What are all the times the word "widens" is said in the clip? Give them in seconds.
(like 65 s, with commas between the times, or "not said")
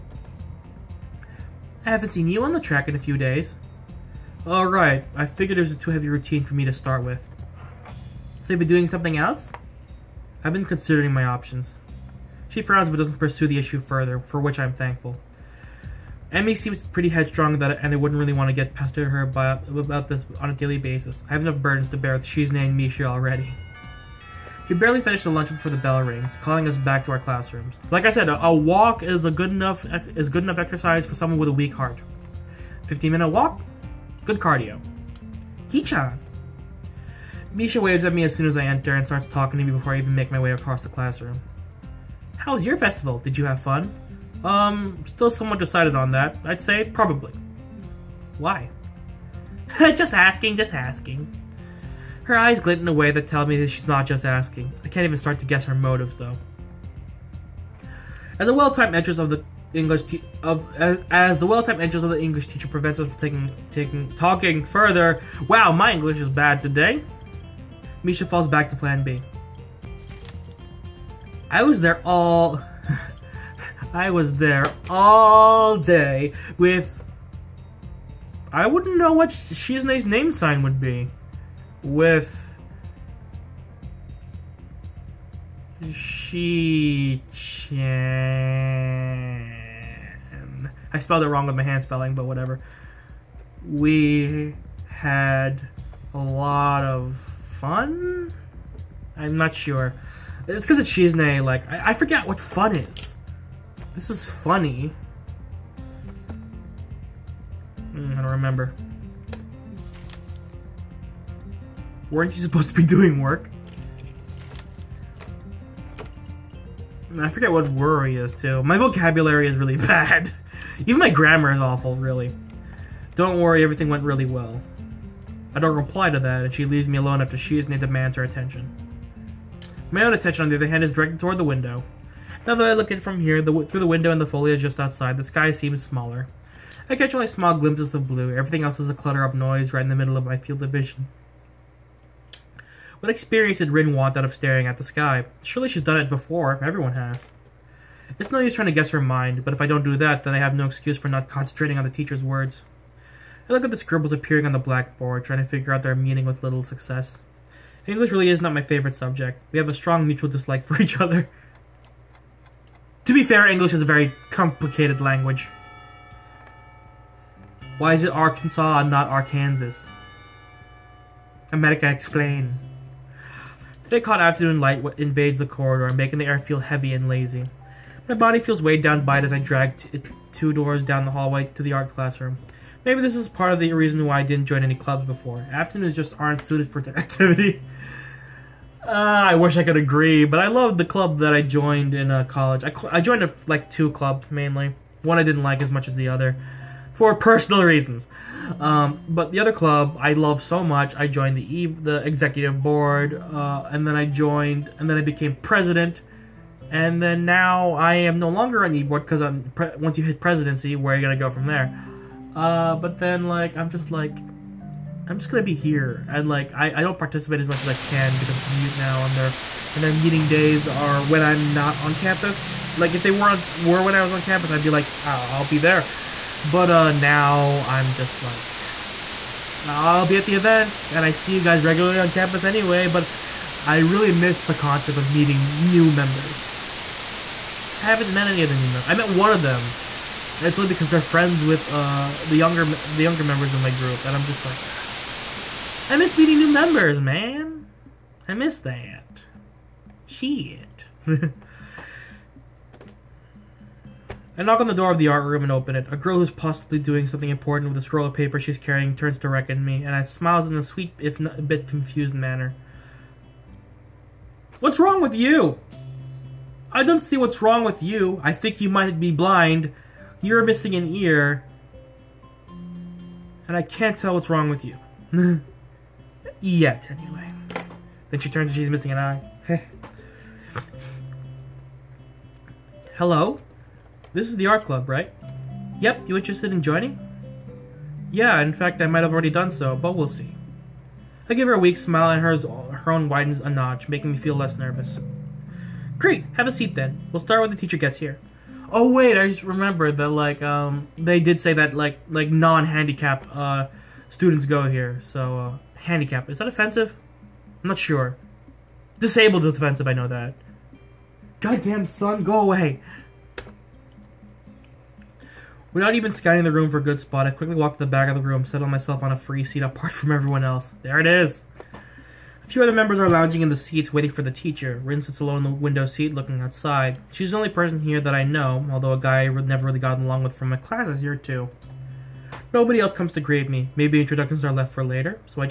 293 s.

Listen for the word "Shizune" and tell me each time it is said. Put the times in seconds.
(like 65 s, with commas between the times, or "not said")
22 s, 100 s.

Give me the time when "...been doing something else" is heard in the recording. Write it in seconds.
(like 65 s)
8 s.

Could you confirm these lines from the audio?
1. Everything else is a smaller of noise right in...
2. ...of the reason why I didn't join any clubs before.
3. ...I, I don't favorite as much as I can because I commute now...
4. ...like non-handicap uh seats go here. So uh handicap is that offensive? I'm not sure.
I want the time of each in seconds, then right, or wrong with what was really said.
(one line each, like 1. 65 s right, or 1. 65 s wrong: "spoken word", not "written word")
1. 138 s wrong: "clutter", not "smaller"
2. 183 s right
3. 216 s wrong: "participate", not "favorite"
4. 302 s wrong: "students", not "seats".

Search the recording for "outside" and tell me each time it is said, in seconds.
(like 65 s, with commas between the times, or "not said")
134 s, 326 s.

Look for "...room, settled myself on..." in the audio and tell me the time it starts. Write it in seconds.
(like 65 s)
318 s.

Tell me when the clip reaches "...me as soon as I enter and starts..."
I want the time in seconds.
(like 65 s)
38 s.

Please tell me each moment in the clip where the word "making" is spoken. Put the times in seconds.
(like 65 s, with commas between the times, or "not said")
175 s, 293 s.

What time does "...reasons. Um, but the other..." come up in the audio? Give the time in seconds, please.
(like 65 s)
197 s.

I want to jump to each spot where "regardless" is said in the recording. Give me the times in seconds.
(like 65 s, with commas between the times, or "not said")
not said.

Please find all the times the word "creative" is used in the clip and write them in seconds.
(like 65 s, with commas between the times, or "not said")
not said.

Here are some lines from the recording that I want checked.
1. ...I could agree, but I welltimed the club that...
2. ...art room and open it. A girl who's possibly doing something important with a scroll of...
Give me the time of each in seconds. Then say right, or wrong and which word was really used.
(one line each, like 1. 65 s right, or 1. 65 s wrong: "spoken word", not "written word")
1. 189 s wrong: "loved", not "welltimed"
2. 255 s right.